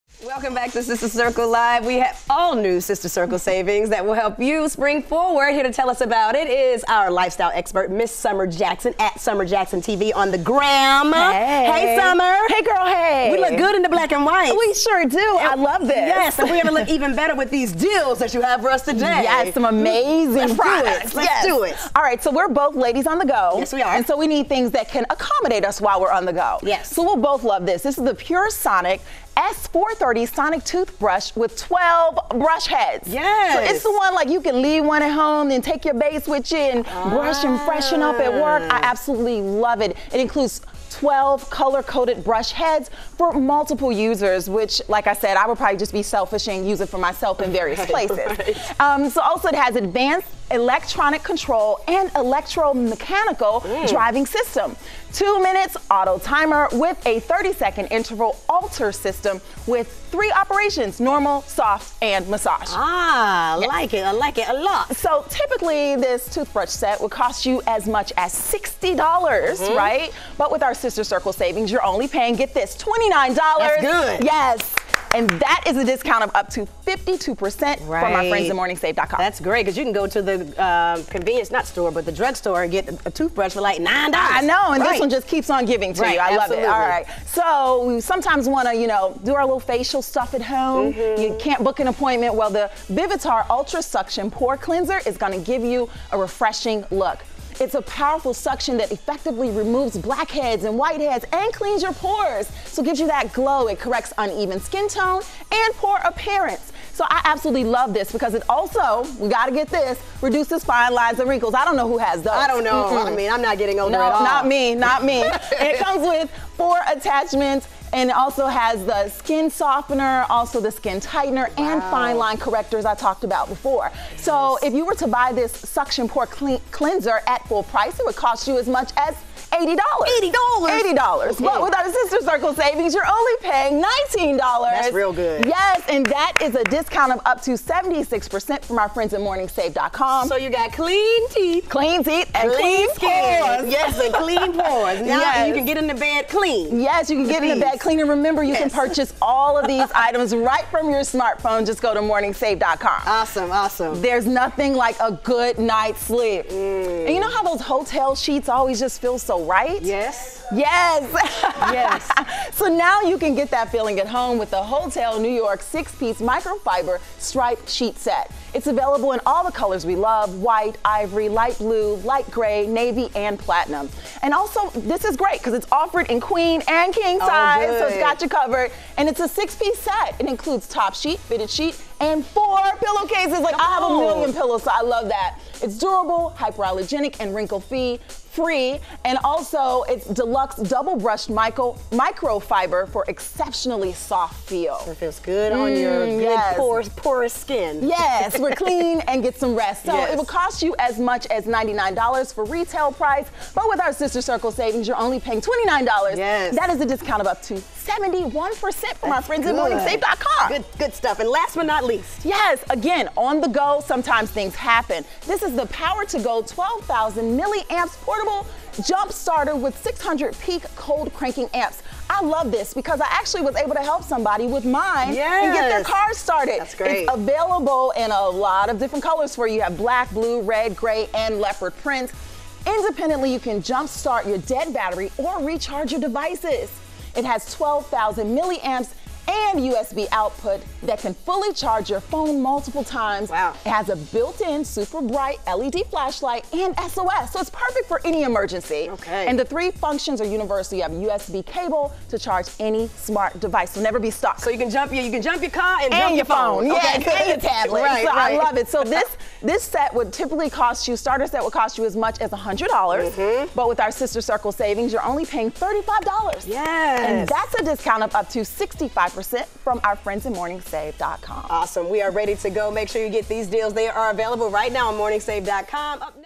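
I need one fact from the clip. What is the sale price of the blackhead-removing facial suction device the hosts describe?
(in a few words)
$19.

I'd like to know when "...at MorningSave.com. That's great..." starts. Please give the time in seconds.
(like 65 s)
78 s.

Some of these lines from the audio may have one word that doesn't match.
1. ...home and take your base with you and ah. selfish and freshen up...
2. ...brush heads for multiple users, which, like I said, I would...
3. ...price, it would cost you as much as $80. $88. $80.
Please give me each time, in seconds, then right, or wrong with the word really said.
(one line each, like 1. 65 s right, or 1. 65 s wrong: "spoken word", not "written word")
1. 35 s wrong: "brush", not "selfish"
2. 42 s right
3. 127 s wrong: "80", not "88".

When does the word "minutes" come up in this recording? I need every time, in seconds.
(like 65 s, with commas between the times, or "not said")
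55 s.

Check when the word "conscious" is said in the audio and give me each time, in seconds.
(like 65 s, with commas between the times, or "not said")
not said.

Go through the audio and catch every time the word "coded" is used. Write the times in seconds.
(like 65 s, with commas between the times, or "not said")
41 s.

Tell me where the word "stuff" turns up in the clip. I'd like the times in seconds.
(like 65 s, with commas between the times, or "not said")
90 s, 210 s.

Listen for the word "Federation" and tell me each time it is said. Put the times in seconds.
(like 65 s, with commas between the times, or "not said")
not said.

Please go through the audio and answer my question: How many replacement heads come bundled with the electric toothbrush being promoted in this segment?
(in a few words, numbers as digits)
12.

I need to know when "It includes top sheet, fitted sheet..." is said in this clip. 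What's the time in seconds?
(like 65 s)
180 s.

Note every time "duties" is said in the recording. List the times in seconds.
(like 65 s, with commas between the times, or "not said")
not said.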